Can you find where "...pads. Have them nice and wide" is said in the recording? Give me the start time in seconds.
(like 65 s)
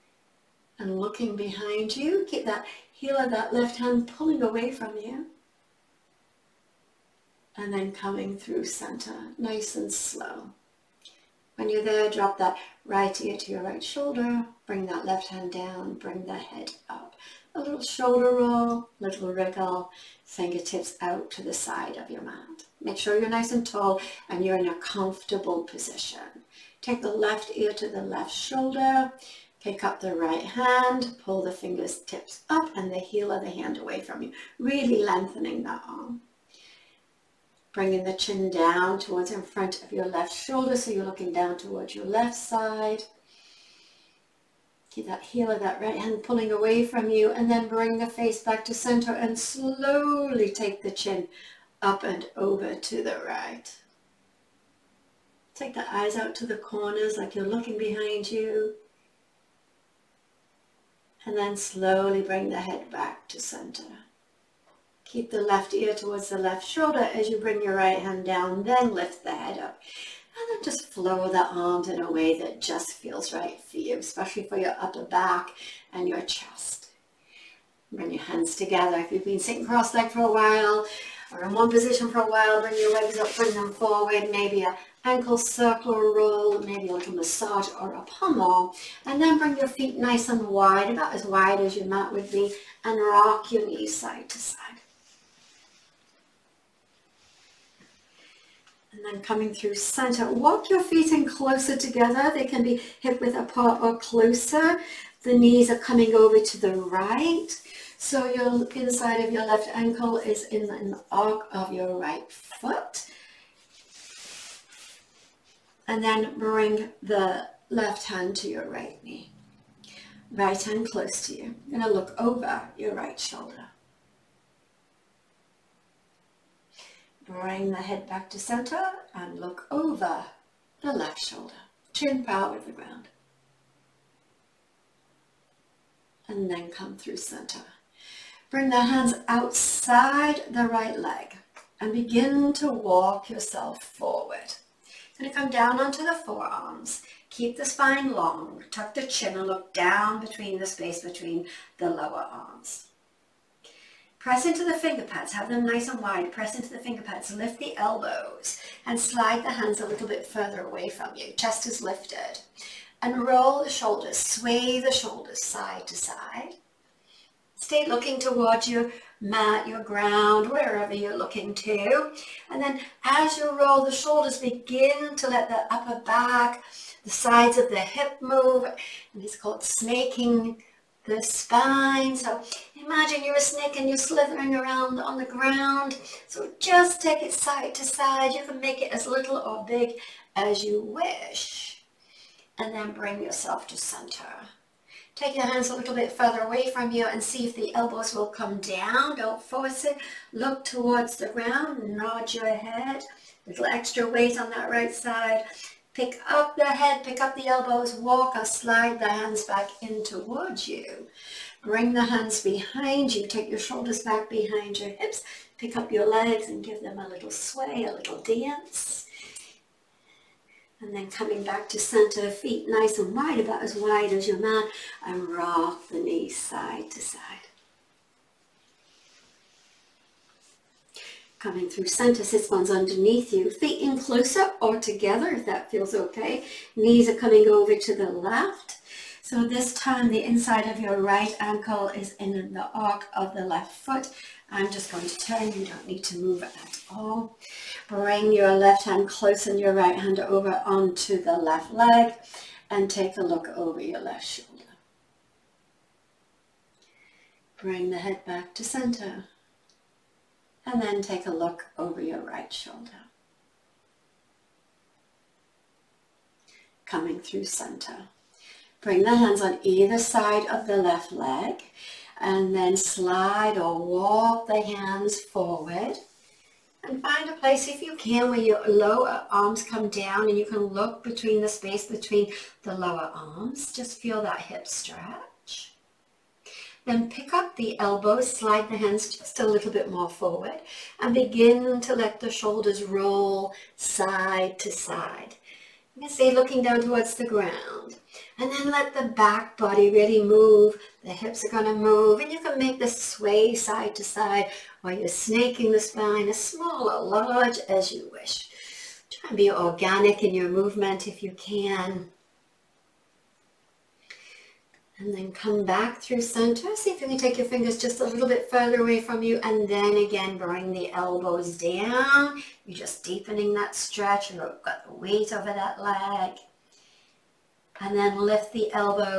155 s.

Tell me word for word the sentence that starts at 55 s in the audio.
Take the eyes out to the corners like you're looking behind you.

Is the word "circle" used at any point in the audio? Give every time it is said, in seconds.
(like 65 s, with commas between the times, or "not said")
85 s.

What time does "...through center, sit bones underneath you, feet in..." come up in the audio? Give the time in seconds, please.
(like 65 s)
231 s.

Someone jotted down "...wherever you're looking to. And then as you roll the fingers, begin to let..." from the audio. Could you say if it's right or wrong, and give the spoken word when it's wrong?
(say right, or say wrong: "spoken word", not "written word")
wrong: "shoulders", not "fingers".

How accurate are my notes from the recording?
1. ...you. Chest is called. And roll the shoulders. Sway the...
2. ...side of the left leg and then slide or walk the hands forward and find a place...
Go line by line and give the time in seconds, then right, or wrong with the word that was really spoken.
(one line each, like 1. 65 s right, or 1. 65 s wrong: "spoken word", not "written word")
1. 161 s wrong: "lifted", not "called"
2. 269 s right.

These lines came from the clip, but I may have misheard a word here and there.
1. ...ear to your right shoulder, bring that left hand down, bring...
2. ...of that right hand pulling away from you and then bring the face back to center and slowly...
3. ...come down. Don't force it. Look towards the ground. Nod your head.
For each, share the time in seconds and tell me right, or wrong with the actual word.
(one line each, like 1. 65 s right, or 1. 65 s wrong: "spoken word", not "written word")
1. 13 s right
2. 45 s right
3. 198 s right.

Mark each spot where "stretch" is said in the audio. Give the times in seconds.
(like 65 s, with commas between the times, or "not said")
284 s, 323 s.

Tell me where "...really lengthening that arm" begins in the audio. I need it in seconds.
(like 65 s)
34 s.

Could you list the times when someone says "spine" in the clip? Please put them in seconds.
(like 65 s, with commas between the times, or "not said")
147 s, 181 s, 305 s.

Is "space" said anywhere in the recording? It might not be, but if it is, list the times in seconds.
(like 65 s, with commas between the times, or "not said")
150 s, 281 s.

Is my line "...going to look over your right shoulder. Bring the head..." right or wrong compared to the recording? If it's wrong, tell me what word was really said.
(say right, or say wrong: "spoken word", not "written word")
right.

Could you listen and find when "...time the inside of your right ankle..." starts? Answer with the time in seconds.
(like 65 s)
239 s.